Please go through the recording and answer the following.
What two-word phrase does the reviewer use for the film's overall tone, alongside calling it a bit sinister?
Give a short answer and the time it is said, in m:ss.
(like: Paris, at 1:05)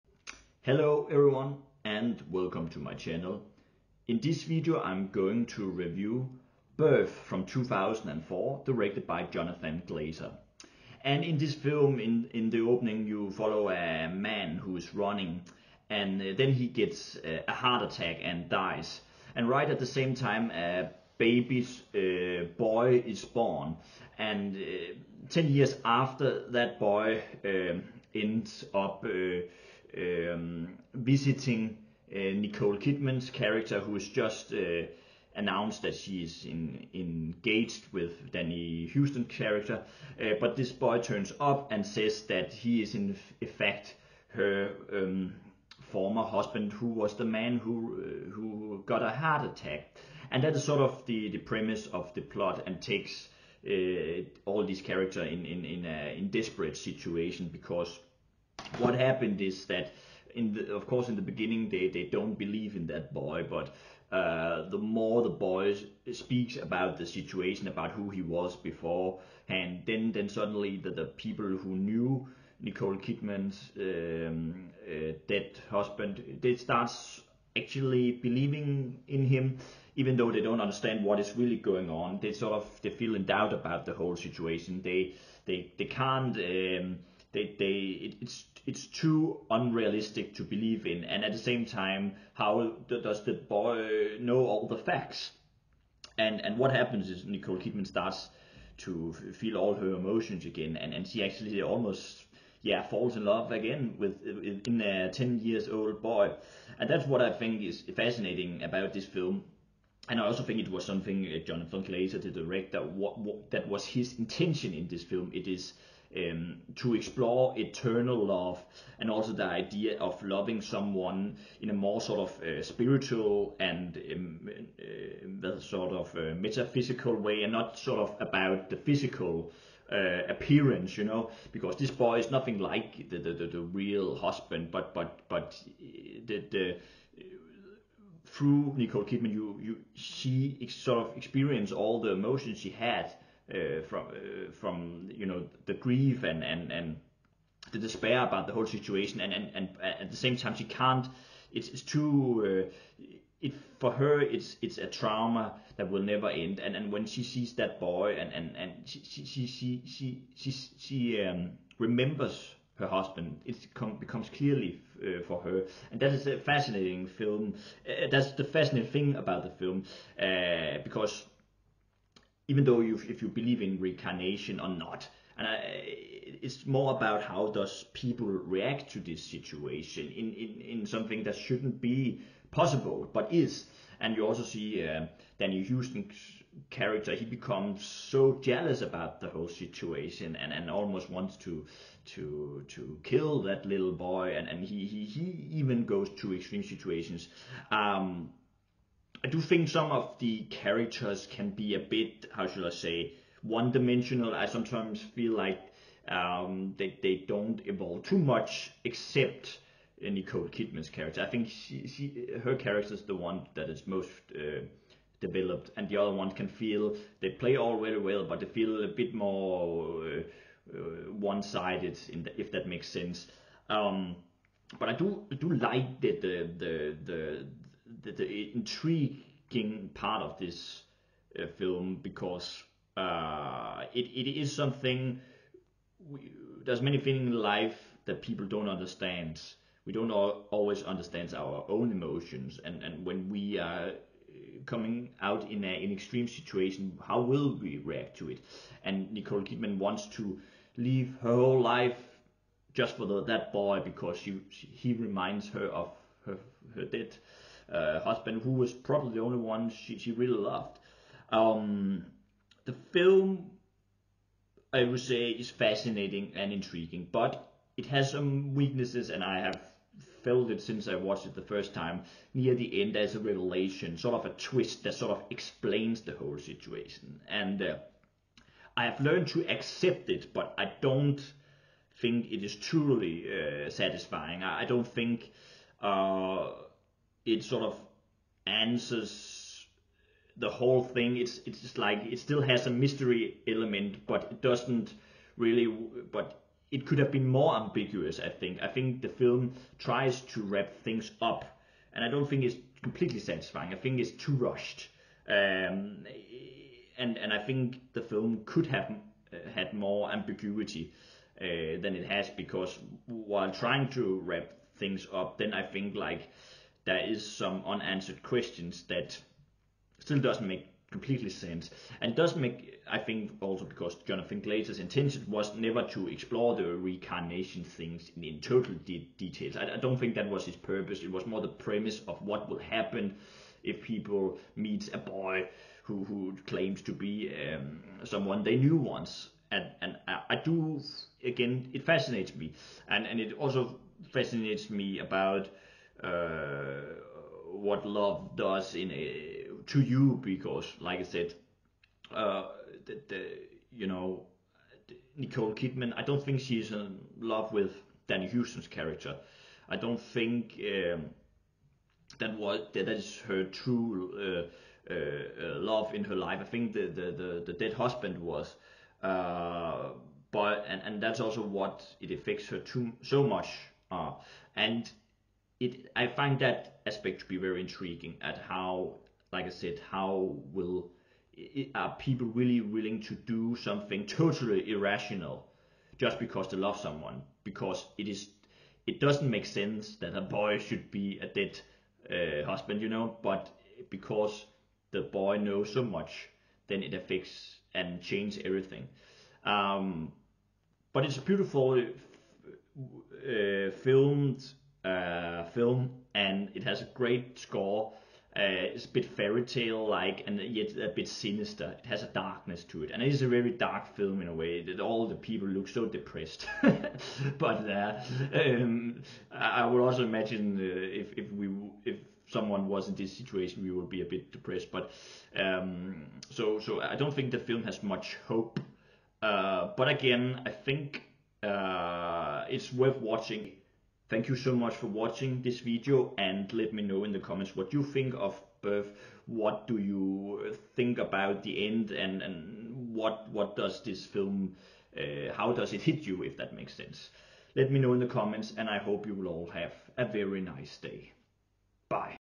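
fairy tale like, at 6:49.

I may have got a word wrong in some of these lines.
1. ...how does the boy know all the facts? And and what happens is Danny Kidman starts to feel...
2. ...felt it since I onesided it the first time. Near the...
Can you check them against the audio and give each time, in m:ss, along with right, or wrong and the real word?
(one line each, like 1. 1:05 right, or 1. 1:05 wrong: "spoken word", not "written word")
1. 1:32 wrong: "Nicole", not "Danny"
2. 4:30 wrong: "watched", not "onesided".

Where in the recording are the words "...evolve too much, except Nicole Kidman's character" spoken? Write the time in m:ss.
3:27.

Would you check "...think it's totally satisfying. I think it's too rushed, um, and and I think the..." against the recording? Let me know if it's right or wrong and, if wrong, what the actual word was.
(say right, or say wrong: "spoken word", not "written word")
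wrong: "completely", not "totally".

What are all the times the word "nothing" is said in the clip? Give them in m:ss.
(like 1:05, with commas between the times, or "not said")
2:12.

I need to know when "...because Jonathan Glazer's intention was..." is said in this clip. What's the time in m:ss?
5:23.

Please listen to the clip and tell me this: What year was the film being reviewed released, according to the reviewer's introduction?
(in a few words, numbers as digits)
2004.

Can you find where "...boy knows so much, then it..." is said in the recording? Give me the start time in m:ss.
6:35.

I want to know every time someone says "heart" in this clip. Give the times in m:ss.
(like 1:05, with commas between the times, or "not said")
0:17, 0:49.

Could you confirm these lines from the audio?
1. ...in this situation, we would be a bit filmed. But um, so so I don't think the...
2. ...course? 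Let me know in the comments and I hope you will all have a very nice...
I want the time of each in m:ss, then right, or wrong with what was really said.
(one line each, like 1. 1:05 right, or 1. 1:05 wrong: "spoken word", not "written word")
1. 7:02 wrong: "depressed", not "filmed"
2. 7:26 wrong: "sense", not "course".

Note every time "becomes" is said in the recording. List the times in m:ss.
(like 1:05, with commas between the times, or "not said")
2:43, 3:07.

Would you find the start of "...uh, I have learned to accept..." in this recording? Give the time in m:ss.
4:37.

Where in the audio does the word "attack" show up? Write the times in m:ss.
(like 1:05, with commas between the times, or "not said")
0:17, 0:49.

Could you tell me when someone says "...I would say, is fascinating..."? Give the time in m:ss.
4:24.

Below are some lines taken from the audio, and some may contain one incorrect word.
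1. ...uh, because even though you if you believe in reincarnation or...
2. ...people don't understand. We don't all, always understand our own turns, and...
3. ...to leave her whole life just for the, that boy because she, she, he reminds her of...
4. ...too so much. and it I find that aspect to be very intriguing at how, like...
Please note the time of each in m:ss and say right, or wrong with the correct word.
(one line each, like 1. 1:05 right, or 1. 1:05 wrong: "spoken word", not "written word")
1. 2:50 right
2. 3:58 wrong: "emotions", not "turns"
3. 4:10 right
4. 6:12 right.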